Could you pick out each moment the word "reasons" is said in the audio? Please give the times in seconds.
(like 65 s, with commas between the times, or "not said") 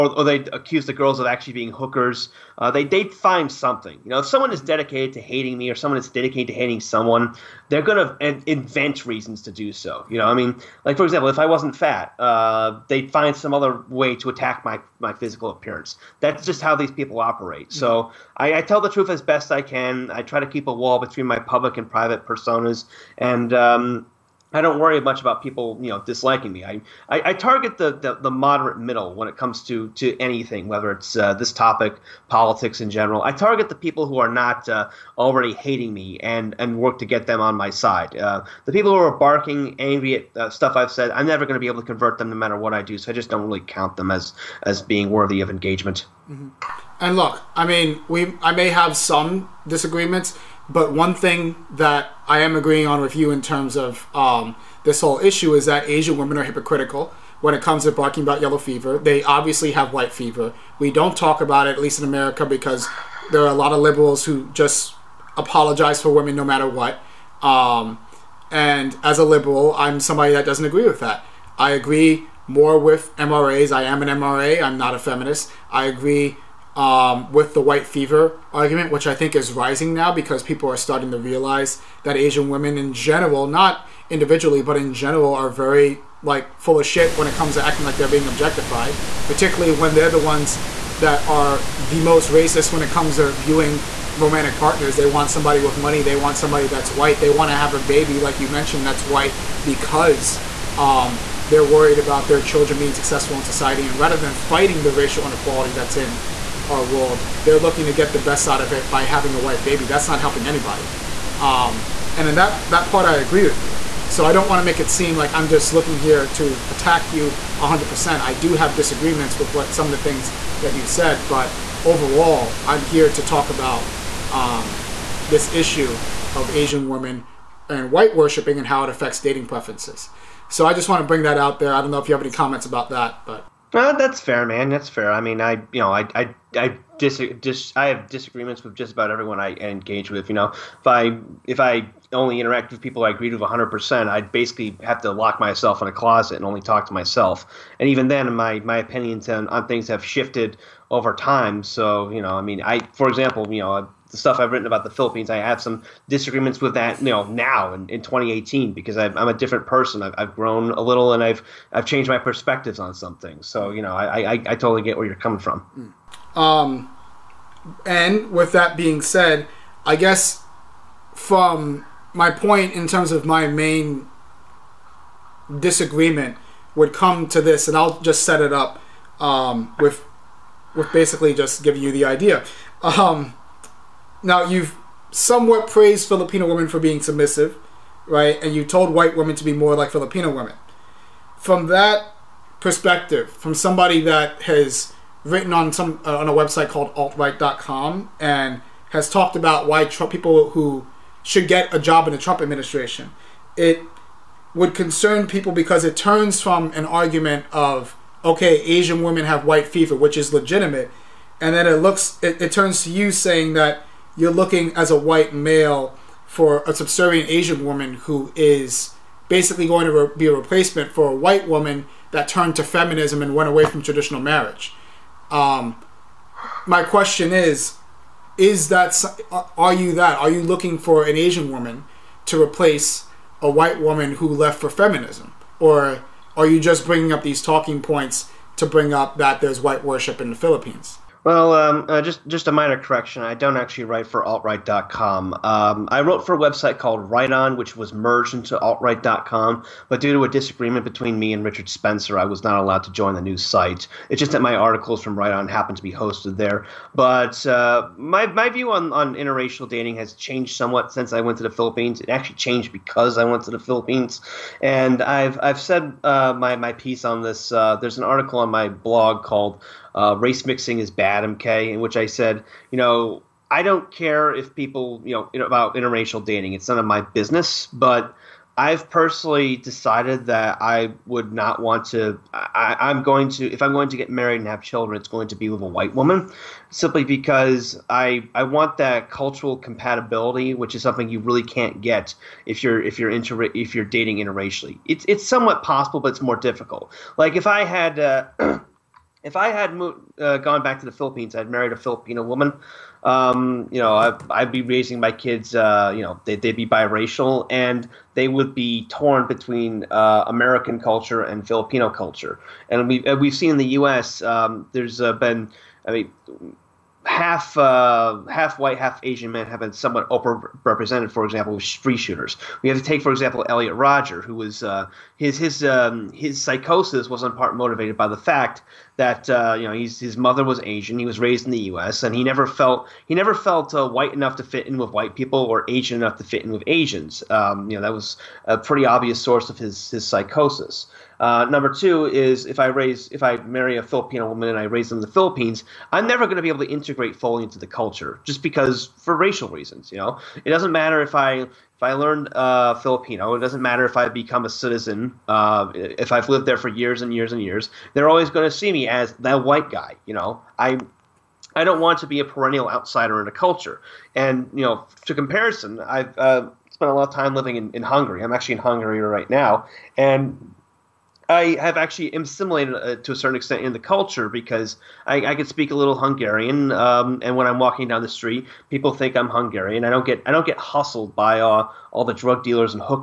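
9 s, 349 s.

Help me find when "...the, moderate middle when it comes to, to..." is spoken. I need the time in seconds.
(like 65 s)
28 s.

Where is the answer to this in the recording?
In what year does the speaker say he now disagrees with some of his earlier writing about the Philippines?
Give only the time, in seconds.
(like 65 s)
157 s.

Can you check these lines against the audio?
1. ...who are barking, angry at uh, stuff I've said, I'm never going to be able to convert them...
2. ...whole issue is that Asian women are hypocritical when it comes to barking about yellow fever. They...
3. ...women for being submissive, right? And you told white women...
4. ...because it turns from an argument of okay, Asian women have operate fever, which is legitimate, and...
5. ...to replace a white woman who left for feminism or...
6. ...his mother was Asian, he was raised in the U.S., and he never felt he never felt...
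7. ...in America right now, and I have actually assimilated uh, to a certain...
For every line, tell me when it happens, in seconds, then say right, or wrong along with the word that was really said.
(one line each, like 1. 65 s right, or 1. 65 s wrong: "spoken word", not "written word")
1. 38 s right
2. 55 s right
3. 186 s right
4. 205 s wrong: "white", not "operate"
5. 232 s right
6. 329 s right
7. 368 s wrong: "Hungary", not "America".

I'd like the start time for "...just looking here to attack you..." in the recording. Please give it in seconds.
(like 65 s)
115 s.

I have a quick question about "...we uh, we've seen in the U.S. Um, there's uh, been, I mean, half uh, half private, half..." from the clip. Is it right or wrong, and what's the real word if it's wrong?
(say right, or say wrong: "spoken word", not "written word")
wrong: "white", not "private".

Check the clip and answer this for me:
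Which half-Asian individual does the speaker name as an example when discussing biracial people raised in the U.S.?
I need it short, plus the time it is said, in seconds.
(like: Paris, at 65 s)
Elliot Rodger, at 323 s.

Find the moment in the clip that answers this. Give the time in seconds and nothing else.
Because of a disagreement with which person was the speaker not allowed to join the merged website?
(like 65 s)
251 s.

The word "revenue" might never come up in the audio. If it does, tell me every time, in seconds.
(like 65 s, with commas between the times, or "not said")
not said.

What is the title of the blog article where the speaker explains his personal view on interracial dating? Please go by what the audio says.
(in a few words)
Race Mixing Is Bad, MK.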